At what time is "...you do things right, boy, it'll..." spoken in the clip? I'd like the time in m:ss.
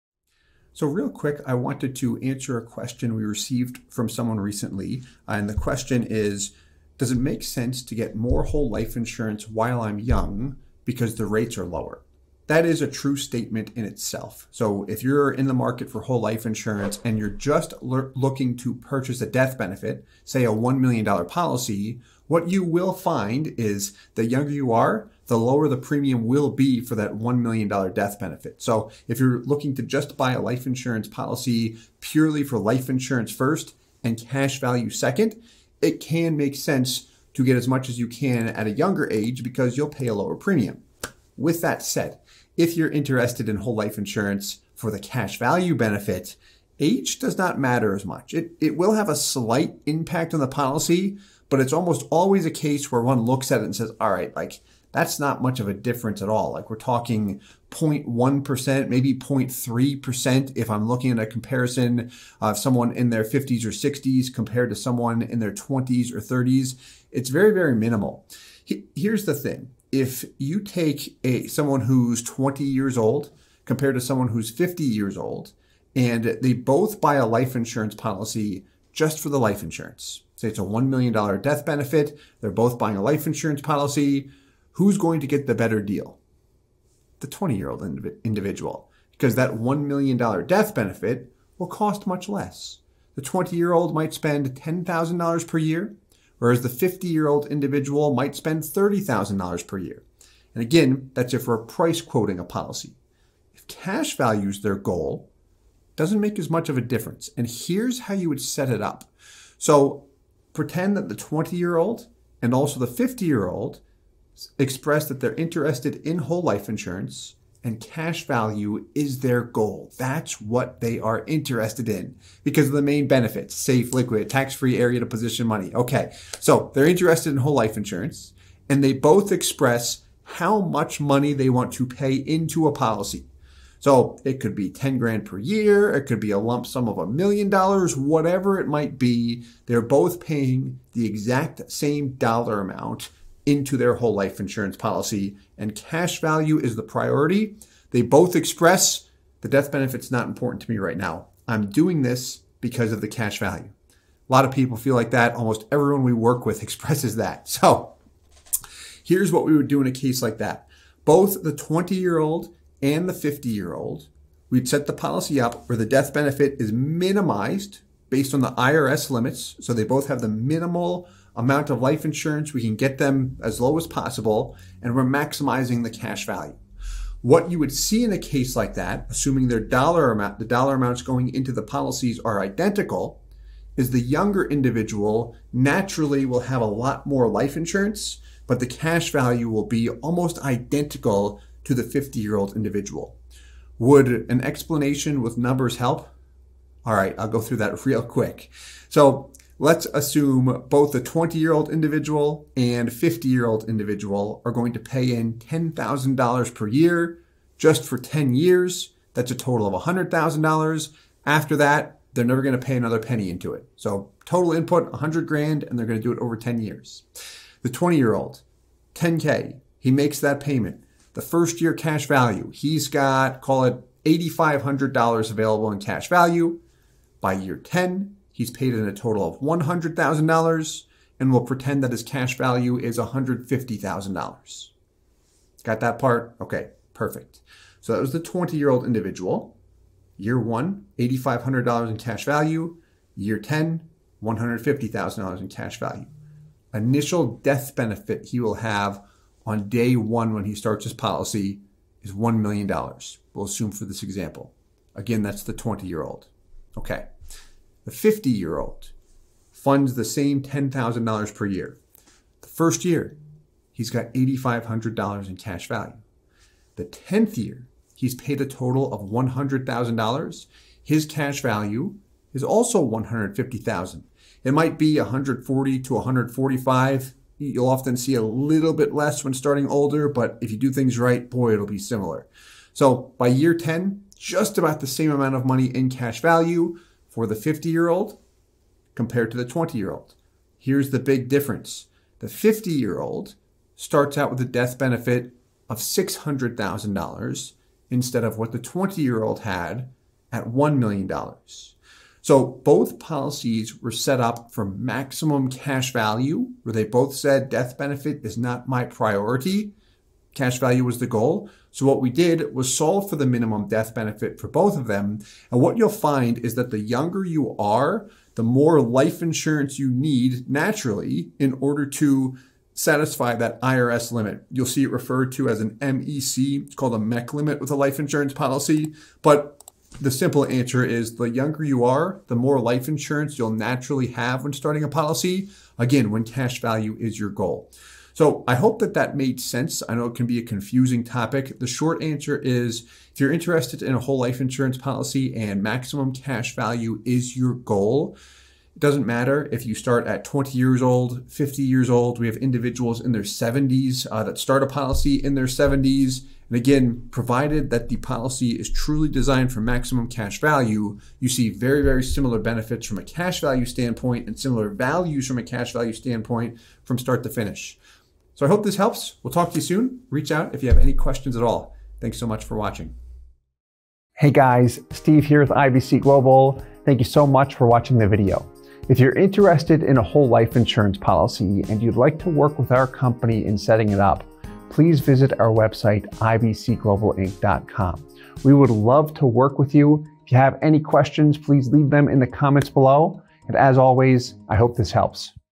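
4:40.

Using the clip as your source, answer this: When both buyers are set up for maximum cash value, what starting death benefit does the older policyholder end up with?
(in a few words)
$600,000.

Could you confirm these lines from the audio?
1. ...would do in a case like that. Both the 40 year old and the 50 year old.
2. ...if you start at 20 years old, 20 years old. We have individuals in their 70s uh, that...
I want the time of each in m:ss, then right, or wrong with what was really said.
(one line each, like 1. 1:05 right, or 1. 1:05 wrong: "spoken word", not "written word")
1. 2:39 wrong: "20", not "40"
2. 5:49 wrong: "50", not "20".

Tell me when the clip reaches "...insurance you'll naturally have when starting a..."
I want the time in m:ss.
5:32.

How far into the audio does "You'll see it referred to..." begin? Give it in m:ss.
5:24.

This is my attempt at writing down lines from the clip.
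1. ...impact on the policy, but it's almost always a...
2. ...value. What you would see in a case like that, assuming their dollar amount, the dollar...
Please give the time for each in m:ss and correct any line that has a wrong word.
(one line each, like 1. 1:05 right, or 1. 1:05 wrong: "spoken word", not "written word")
1. 0:49 right
2. 2:56 right.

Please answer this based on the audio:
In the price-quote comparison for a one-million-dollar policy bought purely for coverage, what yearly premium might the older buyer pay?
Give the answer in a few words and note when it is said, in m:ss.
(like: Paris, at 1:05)
$30,000, at 1:38.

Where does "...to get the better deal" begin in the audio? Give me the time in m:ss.
1:25.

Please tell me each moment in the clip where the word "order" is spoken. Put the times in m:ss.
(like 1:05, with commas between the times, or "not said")
5:21.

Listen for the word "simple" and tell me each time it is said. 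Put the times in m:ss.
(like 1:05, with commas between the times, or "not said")
5:30.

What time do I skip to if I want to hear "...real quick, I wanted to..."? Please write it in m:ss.
0:00.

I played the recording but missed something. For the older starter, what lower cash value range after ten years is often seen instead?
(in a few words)
140 to 145.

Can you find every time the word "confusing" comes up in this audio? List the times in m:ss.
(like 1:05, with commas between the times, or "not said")
5:40.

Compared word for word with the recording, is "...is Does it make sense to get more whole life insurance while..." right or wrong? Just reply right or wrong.
right.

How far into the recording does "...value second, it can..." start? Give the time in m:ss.
0:34.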